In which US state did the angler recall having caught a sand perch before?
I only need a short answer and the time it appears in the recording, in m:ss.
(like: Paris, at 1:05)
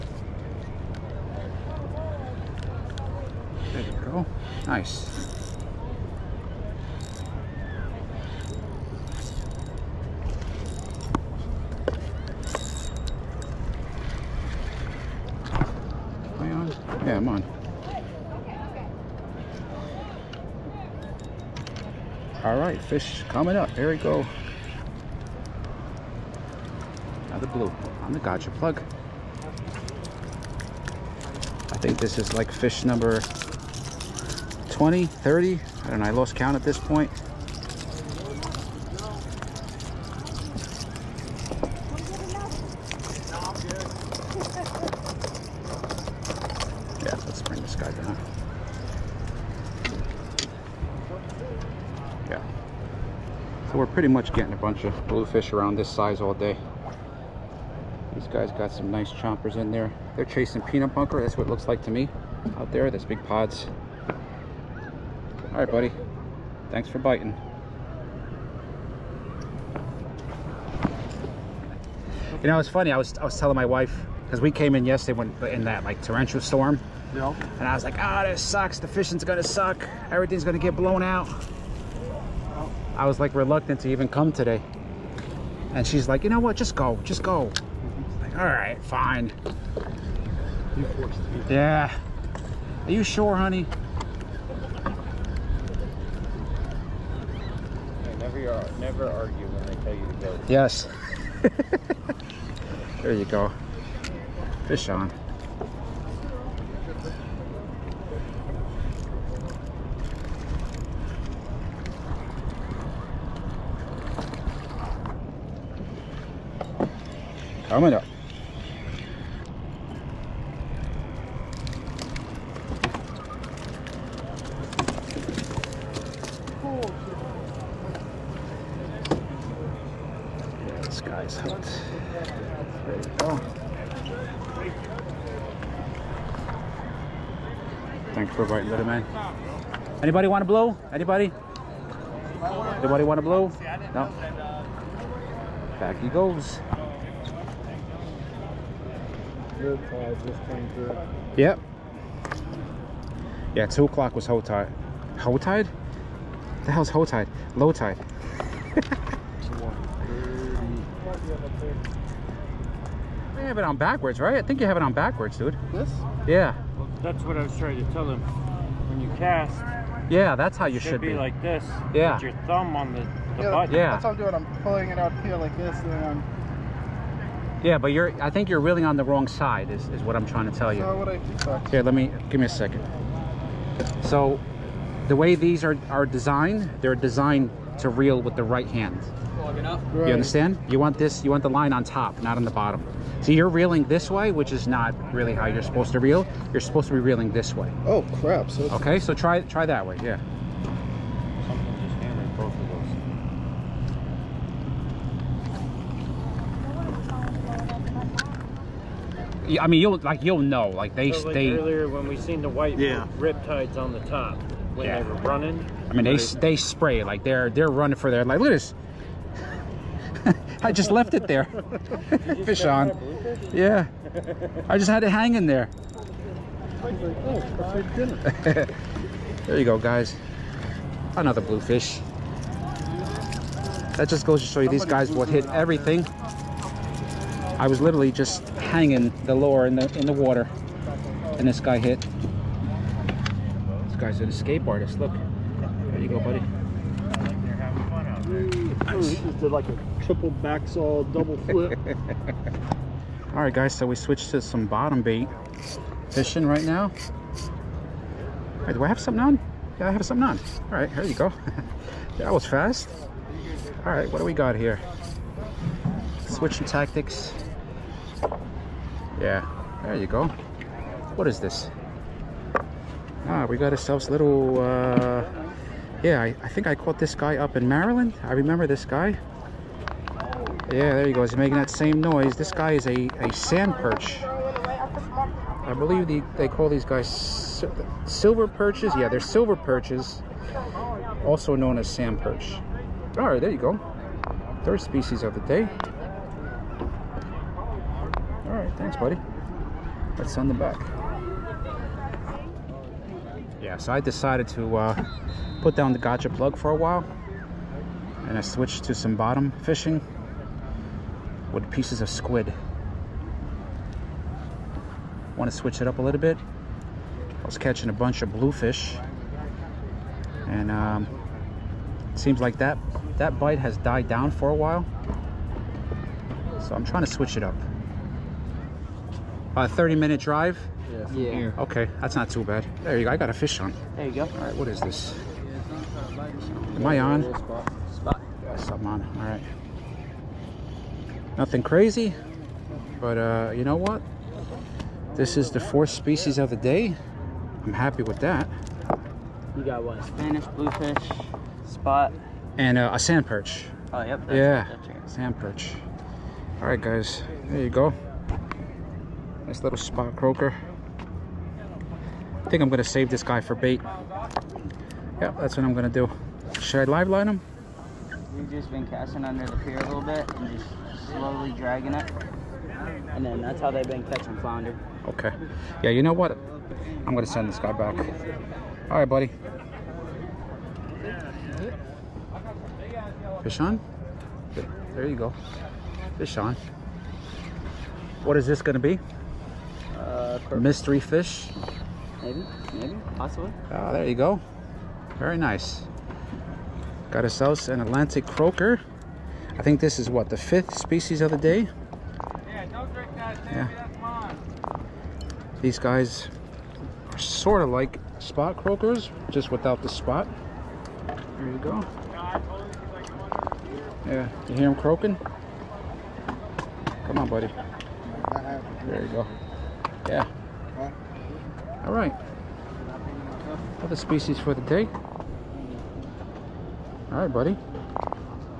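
Maryland, at 4:37.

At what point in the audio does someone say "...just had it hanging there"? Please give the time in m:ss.
3:44.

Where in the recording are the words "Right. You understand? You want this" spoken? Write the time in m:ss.
3:09.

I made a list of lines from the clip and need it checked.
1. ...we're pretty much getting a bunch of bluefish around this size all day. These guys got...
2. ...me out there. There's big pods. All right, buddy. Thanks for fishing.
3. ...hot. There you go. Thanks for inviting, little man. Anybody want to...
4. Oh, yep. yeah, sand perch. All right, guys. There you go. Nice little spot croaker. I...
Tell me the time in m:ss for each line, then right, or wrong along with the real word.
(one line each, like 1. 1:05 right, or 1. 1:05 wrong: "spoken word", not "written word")
1. 0:53 right
2. 1:01 wrong: "biting", not "fishing"
3. 2:11 right
4. 5:53 right.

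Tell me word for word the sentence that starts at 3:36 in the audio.
they spray like they're they're running for their like.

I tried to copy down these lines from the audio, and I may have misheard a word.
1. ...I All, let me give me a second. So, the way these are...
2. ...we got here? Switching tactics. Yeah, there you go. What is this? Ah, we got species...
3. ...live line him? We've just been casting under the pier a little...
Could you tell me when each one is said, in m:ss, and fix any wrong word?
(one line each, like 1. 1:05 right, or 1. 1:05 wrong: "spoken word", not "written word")
1. 3:01 wrong: "Here", not "All"
2. 4:24 wrong: "ourselves", not "species"
3. 6:06 right.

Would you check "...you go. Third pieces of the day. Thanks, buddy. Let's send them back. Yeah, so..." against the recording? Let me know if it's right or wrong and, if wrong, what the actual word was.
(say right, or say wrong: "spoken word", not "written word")
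wrong: "species", not "pieces".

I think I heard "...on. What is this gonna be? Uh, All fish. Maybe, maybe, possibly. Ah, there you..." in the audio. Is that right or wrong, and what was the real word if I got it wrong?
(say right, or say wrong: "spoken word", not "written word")
wrong: "Mystery", not "All".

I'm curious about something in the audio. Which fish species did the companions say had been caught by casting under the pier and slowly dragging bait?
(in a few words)
flounder.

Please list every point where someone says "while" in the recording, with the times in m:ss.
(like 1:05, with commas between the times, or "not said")
5:06, 5:24.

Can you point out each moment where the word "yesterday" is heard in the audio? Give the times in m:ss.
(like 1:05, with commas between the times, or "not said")
1:14.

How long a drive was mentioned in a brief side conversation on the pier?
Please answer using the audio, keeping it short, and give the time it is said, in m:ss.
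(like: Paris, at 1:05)
30 minute, at 5:29.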